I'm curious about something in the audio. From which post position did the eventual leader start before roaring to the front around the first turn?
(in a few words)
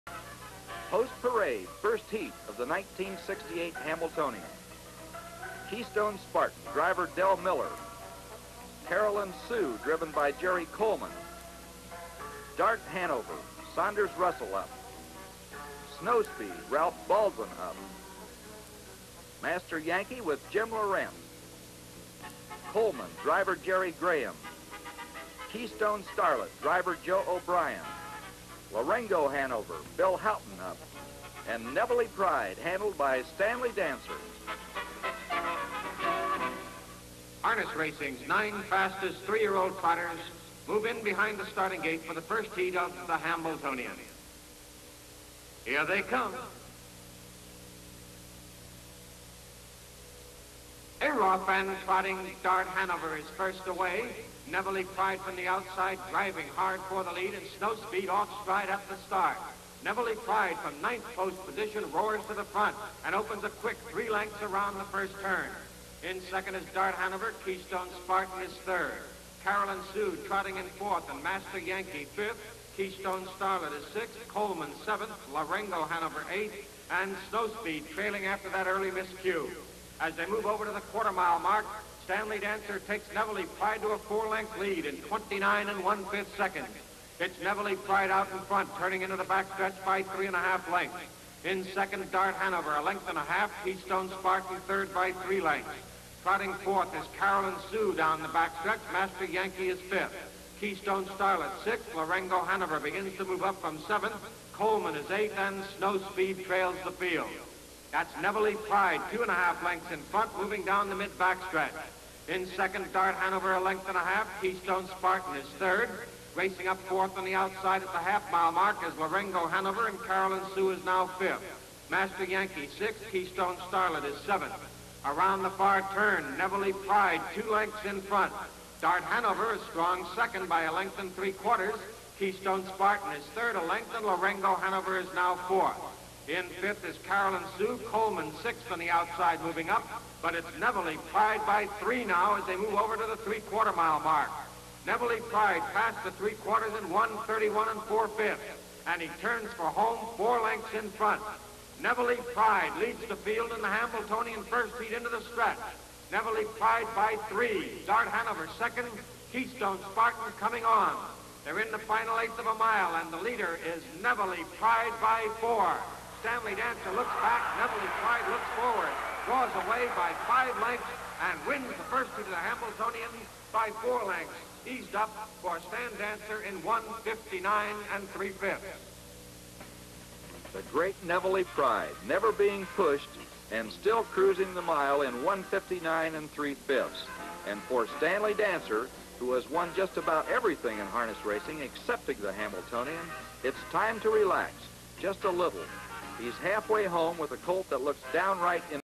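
9th.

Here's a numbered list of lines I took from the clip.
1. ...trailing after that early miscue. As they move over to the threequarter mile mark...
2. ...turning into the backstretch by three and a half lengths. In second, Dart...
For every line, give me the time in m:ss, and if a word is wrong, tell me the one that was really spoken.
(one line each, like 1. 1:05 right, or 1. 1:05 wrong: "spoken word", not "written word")
1. 1:17 wrong: "quarter", not "threequarter"
2. 1:28 right.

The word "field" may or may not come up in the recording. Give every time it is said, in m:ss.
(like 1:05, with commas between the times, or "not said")
1:46, 2:33.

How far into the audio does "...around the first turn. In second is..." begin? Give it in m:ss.
1:04.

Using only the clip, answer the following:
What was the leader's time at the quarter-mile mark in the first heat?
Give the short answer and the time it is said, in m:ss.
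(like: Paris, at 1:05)
29 1/5 seconds, at 1:24.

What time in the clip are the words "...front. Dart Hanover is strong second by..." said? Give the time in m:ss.
2:08.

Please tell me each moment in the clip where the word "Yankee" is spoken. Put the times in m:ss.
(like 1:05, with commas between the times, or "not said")
0:19, 1:11, 1:39, 2:02.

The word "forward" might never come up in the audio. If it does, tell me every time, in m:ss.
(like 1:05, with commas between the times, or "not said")
2:48.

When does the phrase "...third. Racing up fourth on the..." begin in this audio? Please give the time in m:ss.
1:55.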